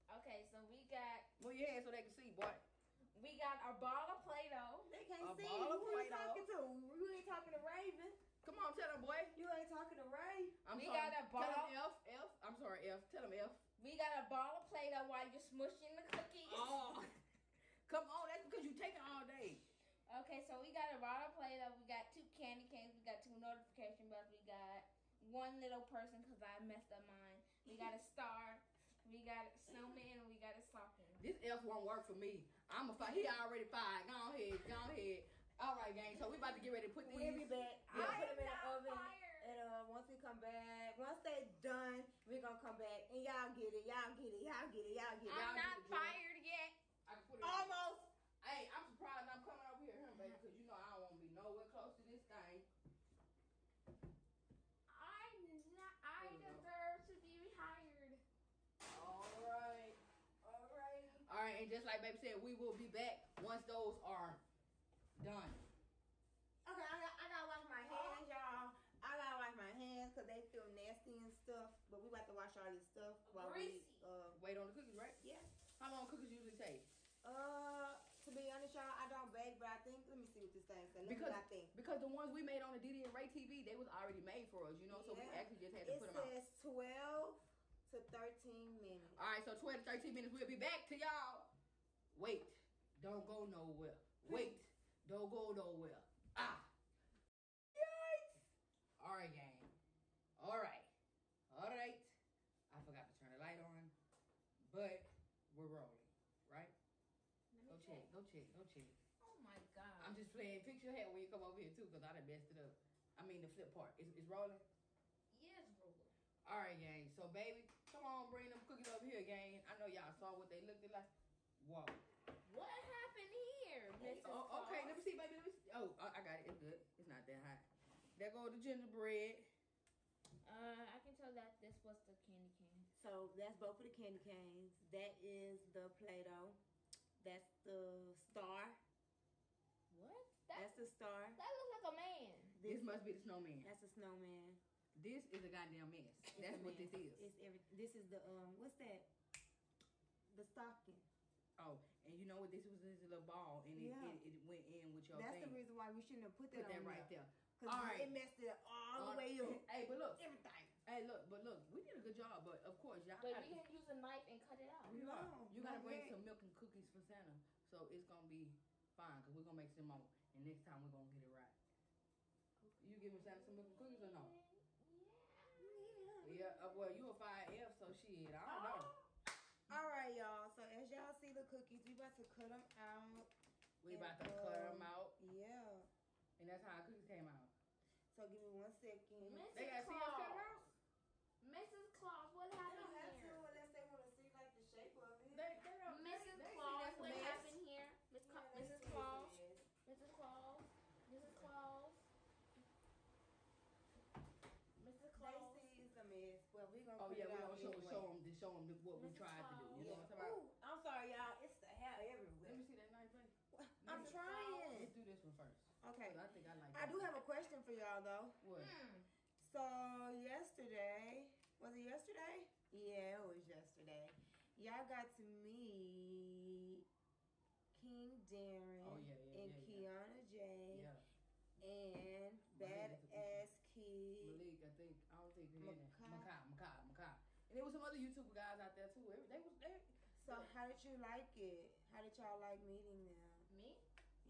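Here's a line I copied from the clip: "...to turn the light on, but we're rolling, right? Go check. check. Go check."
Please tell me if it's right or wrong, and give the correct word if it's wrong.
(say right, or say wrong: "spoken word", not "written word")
right.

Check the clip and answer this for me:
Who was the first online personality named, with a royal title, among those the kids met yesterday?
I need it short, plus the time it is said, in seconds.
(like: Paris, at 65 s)
King Darren, at 227 s.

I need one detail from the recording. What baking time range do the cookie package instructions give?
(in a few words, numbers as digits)
12 to 13 minutes.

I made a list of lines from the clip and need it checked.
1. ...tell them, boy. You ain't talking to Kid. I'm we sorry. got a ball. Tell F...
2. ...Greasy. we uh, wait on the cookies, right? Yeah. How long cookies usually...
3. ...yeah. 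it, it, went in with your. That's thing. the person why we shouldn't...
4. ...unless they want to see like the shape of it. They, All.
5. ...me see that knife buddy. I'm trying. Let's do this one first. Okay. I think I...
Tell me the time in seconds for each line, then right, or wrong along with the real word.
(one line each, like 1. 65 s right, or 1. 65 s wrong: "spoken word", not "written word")
1. 8 s wrong: "Ray", not "Kid"
2. 73 s right
3. 153 s wrong: "reason", not "person"
4. 193 s wrong: "Mrs", not "All"
5. 212 s right.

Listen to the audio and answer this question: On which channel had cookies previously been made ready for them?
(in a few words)
Deedy and Rae TV.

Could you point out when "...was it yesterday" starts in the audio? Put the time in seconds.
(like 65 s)
221 s.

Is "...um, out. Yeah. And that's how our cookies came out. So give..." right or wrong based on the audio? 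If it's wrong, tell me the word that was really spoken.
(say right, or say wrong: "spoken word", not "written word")
right.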